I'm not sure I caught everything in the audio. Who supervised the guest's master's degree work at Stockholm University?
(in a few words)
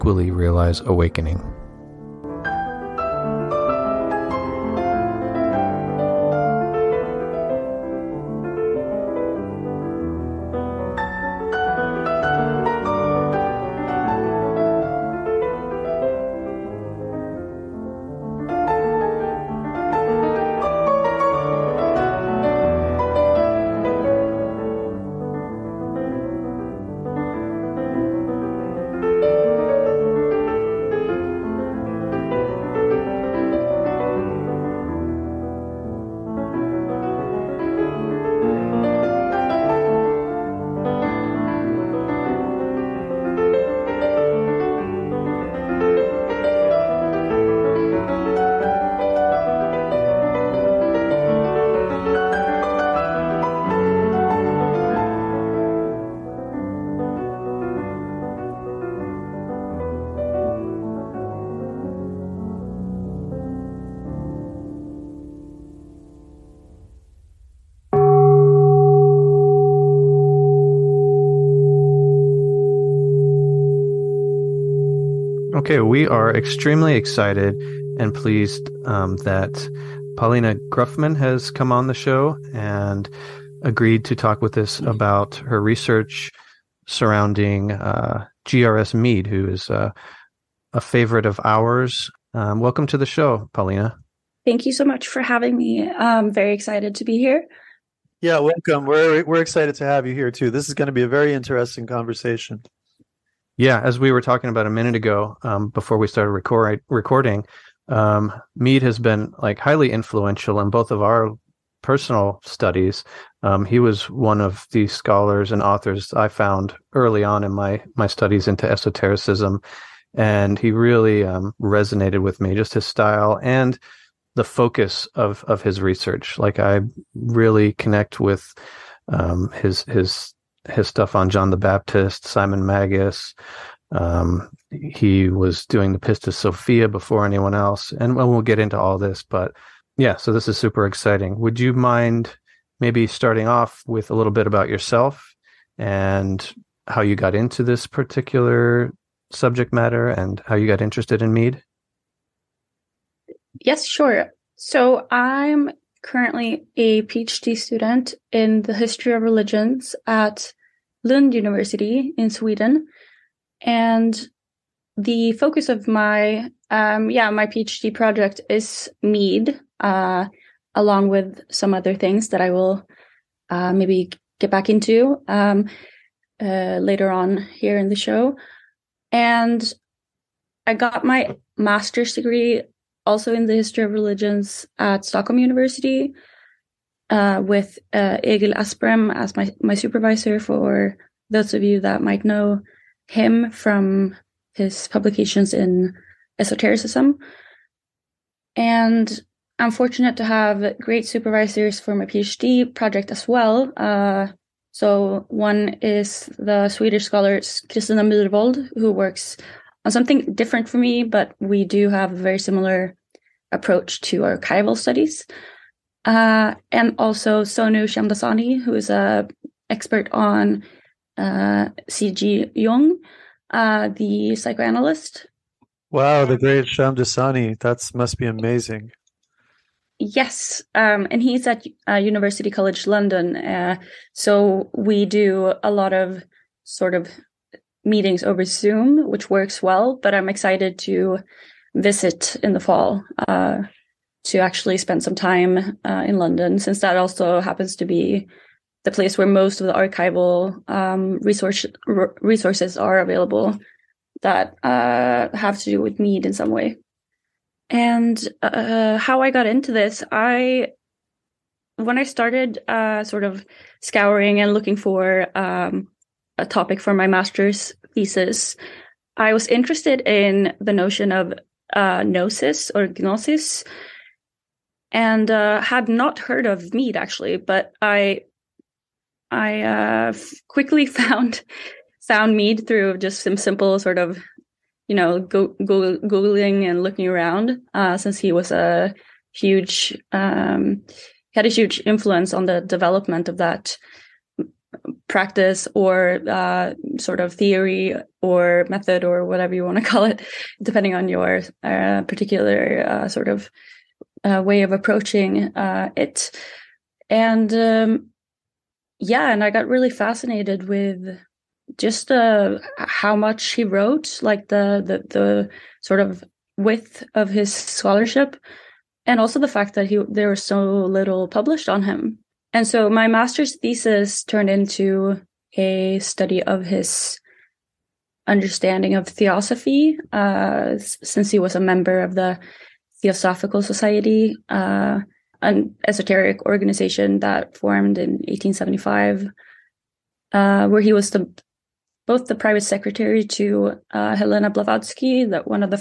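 Egil Asprem.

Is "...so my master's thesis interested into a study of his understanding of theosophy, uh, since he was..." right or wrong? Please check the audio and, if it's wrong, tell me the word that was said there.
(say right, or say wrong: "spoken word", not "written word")
wrong: "turned", not "interested".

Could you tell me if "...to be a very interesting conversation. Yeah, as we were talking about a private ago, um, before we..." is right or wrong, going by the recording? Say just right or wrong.
wrong.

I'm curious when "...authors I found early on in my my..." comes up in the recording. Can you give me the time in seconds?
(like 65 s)
115 s.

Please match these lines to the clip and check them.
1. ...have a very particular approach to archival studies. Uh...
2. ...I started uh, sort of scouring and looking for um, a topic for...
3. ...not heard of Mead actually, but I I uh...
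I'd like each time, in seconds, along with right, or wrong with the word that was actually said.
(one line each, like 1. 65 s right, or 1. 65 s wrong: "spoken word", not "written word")
1. 211 s wrong: "similar", not "particular"
2. 261 s right
3. 275 s right.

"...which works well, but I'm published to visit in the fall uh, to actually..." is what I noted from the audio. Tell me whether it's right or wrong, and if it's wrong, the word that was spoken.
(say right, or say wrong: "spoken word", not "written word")
wrong: "excited", not "published".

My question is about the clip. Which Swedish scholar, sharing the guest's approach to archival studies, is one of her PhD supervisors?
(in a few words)
Kristina Myrvold.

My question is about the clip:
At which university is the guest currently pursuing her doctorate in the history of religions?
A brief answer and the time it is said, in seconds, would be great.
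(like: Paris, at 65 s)
Lund University, at 161 s.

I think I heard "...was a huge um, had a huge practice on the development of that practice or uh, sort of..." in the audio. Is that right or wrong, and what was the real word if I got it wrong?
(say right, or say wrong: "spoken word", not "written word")
wrong: "influence", not "practice".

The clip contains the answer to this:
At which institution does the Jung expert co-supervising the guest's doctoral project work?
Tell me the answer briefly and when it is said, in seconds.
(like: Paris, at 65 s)
University College London, at 231 s.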